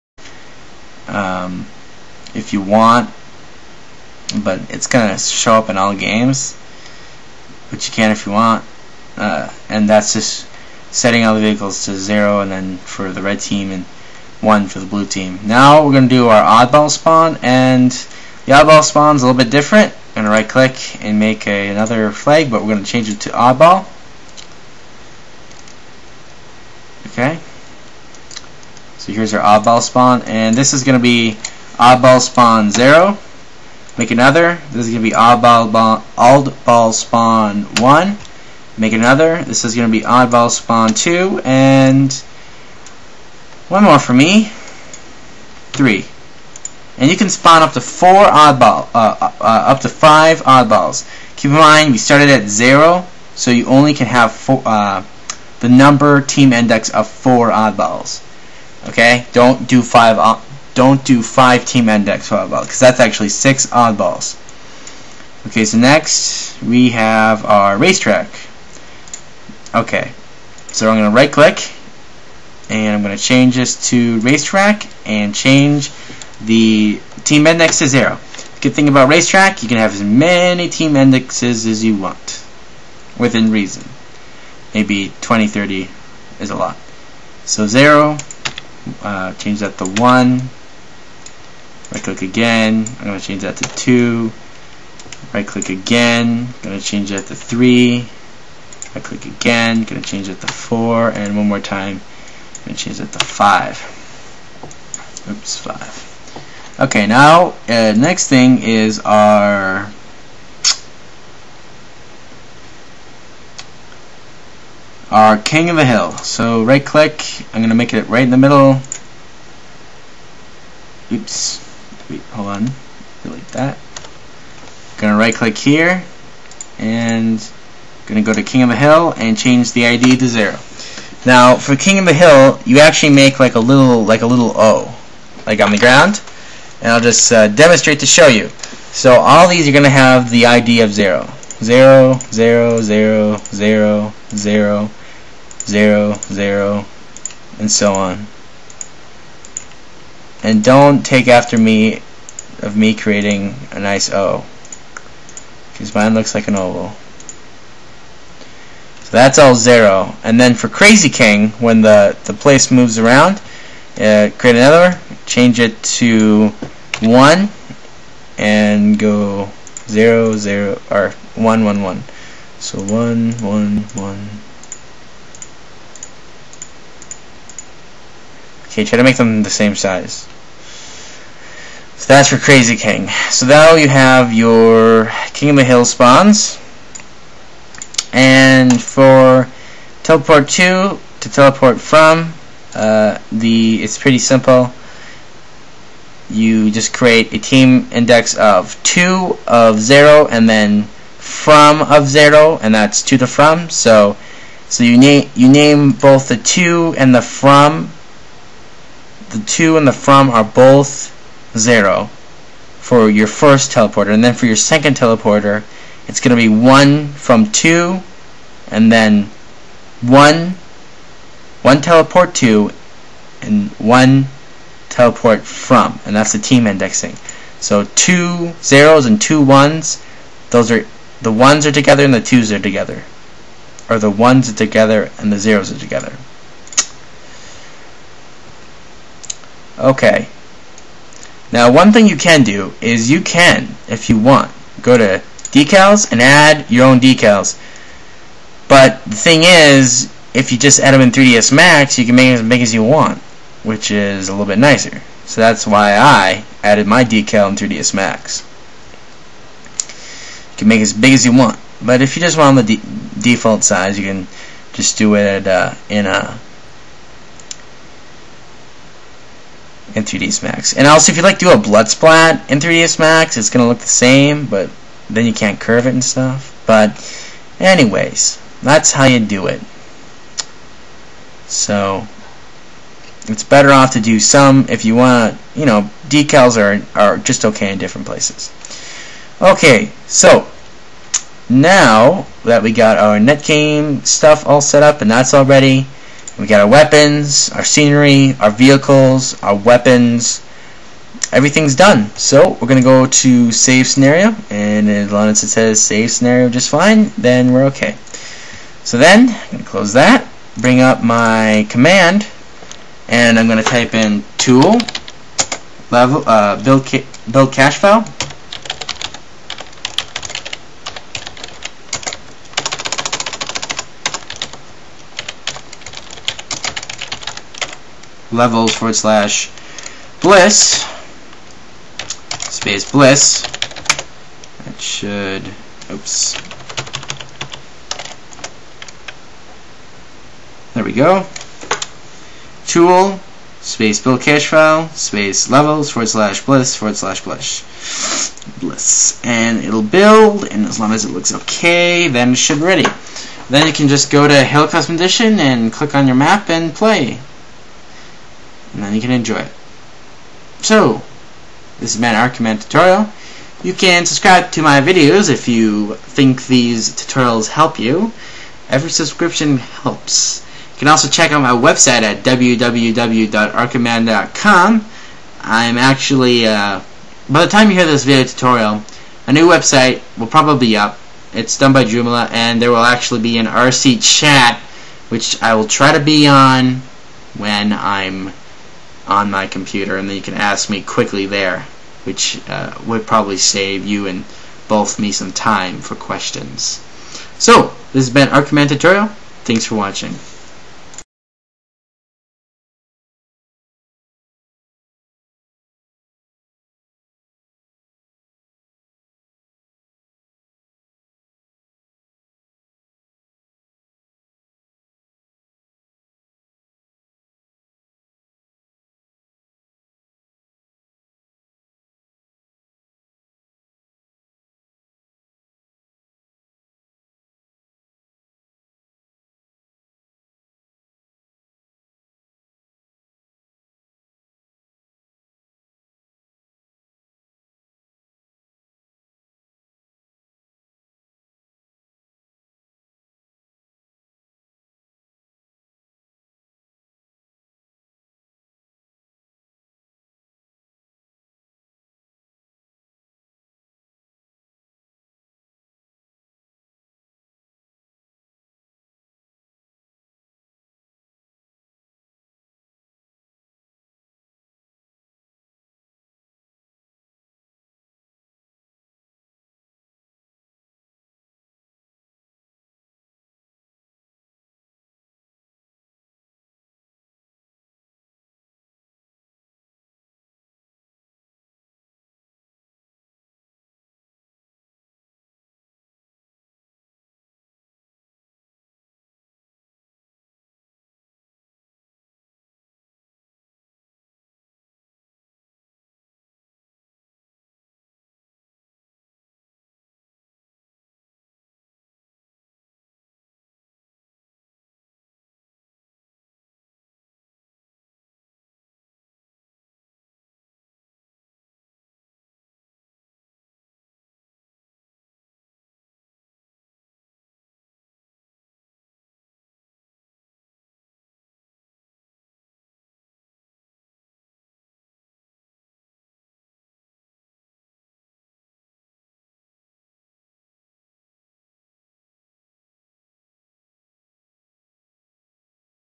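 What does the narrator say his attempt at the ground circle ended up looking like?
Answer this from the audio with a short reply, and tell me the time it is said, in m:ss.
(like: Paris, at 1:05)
an oval, at 2:36.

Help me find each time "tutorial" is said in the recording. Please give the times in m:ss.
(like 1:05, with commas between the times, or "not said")
6:02, 6:06, 6:18, 6:38.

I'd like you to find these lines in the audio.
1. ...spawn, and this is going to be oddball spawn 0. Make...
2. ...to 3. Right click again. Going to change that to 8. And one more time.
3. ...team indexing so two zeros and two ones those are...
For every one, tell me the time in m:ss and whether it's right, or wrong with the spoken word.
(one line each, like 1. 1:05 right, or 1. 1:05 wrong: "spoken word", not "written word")
1. 0:29 right
2. 1:37 wrong: "4", not "8"
3. 3:46 right.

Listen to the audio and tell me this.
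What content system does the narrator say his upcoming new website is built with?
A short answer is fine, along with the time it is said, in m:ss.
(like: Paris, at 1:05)
Joomla, at 6:21.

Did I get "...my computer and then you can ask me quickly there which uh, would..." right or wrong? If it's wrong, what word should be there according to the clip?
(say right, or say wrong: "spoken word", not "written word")
right.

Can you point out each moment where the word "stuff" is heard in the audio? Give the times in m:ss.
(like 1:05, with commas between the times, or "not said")
4:36, 4:54.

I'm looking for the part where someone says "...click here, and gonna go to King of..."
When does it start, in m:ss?
2:05.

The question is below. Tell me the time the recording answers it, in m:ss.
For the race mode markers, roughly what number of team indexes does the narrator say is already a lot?
1:25.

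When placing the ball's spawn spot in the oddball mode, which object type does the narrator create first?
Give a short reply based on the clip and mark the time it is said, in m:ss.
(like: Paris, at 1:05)
flag, at 0:22.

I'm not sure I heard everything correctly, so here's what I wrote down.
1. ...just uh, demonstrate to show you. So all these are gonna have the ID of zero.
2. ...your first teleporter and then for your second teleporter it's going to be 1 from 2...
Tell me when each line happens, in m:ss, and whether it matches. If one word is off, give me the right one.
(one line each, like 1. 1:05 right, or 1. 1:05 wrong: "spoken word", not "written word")
1. 2:17 right
2. 3:33 right.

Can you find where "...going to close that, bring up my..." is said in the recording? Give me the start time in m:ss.
5:09.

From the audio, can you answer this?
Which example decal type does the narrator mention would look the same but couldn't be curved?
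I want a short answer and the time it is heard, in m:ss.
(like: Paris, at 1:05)
blood splat, at 4:31.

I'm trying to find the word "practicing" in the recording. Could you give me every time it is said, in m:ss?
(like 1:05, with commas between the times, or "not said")
not said.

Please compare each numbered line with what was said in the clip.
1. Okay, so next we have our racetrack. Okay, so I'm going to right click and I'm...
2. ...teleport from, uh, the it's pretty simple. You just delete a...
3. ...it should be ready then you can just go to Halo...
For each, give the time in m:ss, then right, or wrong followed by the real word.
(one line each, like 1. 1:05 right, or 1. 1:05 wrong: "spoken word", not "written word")
1. 1:05 right
2. 3:11 wrong: "create", not "delete"
3. 5:52 right.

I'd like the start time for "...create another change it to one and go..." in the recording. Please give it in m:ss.
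2:44.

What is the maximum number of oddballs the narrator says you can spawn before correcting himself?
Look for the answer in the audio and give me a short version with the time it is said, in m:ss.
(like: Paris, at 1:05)
5, at 0:49.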